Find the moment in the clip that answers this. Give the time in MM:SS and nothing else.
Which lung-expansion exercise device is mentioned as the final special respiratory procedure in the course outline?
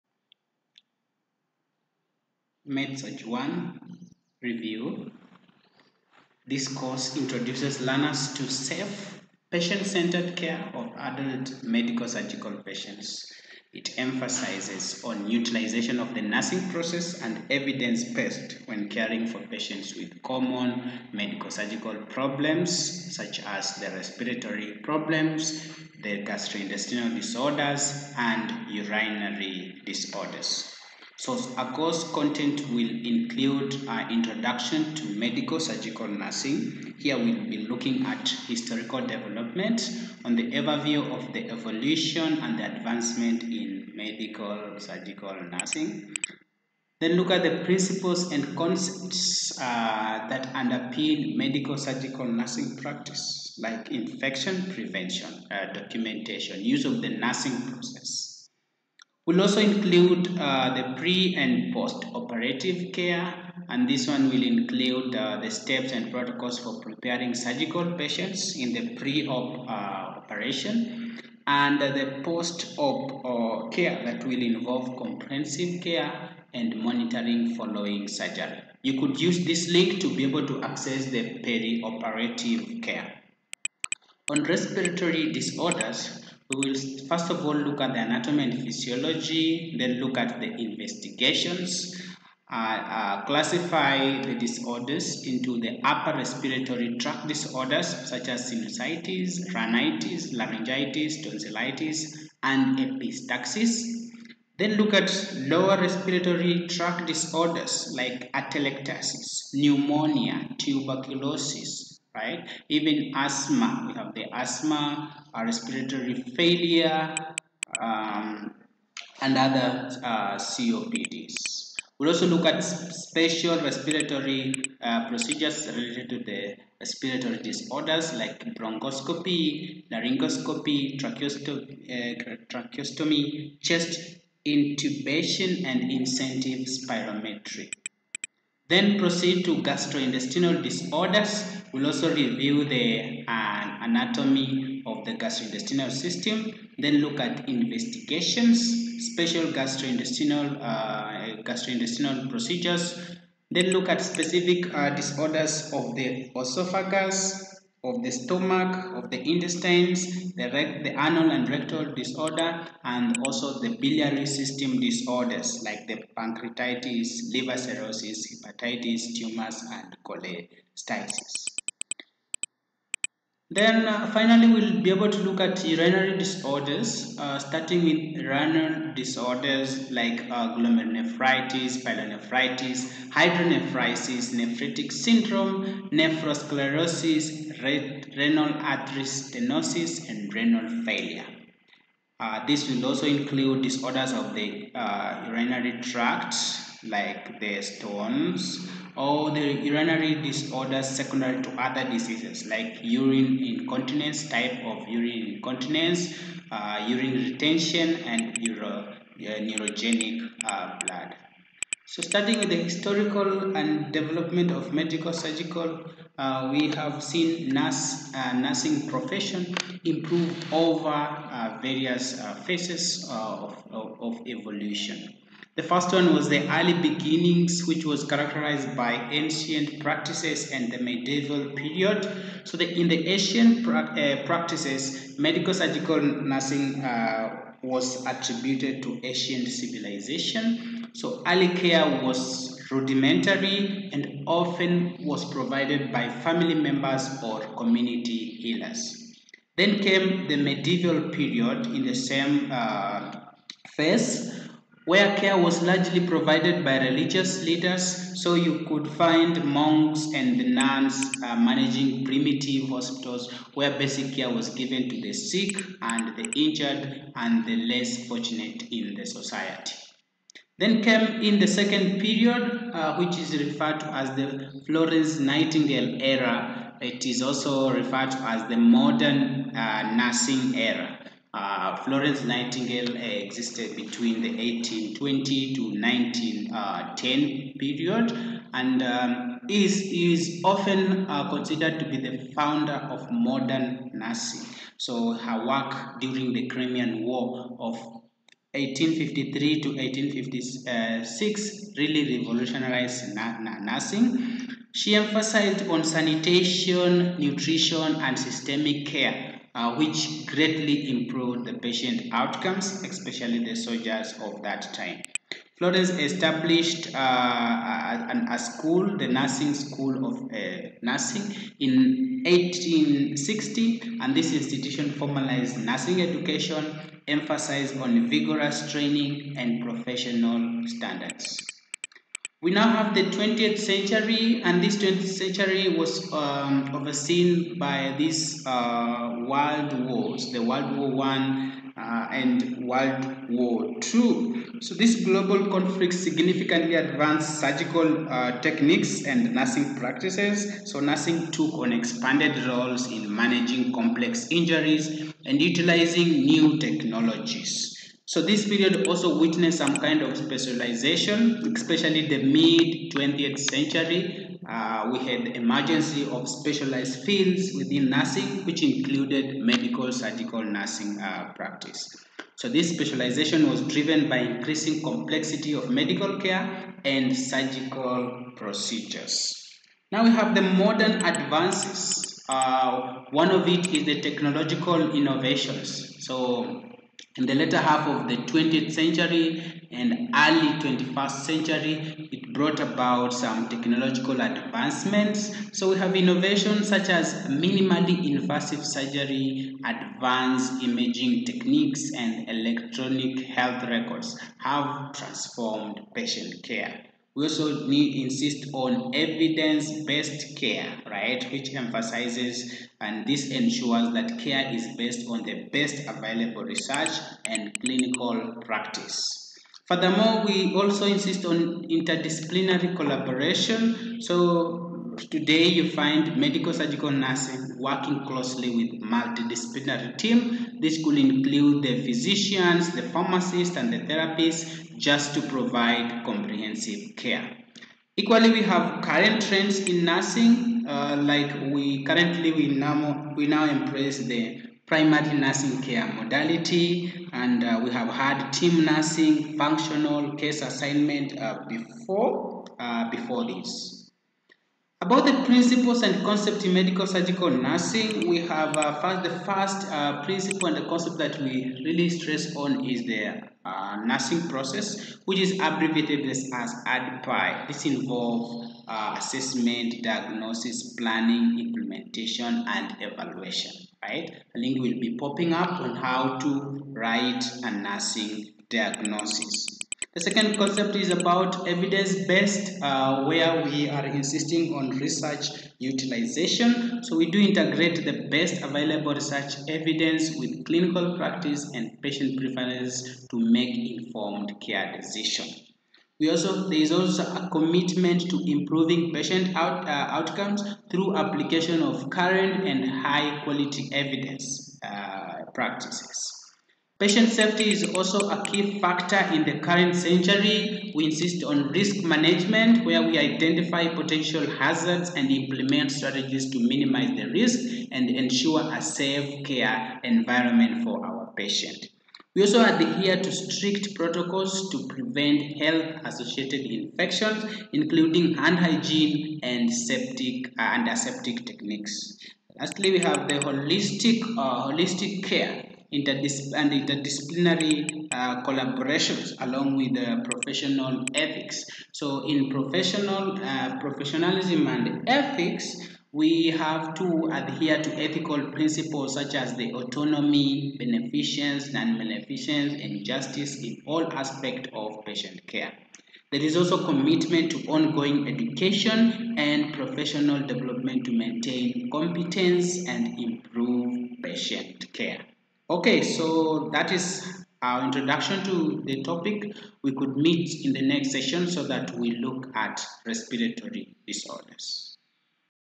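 02:15.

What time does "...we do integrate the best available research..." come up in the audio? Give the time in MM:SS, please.
08:06.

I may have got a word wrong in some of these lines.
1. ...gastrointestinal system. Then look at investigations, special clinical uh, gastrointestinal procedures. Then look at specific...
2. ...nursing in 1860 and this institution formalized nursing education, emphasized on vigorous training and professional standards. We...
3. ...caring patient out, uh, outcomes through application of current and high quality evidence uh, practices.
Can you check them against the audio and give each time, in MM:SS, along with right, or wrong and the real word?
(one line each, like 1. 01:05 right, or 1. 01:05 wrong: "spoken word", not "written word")
1. 02:25 wrong: "gastrointestinal", not "clinical"
2. 05:20 right
3. 08:18 wrong: "improving", not "caring".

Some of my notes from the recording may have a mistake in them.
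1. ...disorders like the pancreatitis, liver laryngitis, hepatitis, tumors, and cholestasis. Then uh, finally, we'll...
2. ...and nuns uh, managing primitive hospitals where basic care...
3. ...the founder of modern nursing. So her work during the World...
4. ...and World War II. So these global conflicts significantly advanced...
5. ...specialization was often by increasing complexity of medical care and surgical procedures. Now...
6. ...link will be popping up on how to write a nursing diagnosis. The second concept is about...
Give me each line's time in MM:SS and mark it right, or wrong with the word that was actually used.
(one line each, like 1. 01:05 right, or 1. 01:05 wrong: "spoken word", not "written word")
1. 02:44 wrong: "cirrhosis", not "laryngitis"
2. 04:20 right
3. 04:52 wrong: "Crimean", not "World"
4. 05:42 right
5. 06:12 wrong: "driven", not "often"
6. 07:54 right.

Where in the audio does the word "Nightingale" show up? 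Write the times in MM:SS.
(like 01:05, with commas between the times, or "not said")
04:35, 04:42.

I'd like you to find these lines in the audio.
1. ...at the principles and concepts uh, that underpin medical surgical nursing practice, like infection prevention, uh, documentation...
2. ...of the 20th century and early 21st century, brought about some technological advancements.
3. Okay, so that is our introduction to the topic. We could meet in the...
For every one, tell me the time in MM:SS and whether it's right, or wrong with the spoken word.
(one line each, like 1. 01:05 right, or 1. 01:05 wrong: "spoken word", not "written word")
1. 00:47 right
2. 06:27 right
3. 09:25 right.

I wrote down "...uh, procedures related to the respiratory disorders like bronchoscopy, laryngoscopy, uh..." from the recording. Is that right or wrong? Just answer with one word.
right.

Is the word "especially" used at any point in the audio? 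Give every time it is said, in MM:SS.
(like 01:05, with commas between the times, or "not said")
05:12, 06:01.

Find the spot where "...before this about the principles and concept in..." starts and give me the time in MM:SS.
07:32.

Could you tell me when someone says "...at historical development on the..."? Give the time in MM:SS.
00:38.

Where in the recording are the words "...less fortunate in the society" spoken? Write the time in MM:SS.
04:27.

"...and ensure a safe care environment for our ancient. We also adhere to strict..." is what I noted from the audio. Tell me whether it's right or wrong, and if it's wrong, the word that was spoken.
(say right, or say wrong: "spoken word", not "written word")
wrong: "patient", not "ancient".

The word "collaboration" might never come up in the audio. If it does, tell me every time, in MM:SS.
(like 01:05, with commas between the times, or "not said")
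07:02, 08:58.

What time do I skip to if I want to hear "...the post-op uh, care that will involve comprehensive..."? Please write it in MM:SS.
01:11.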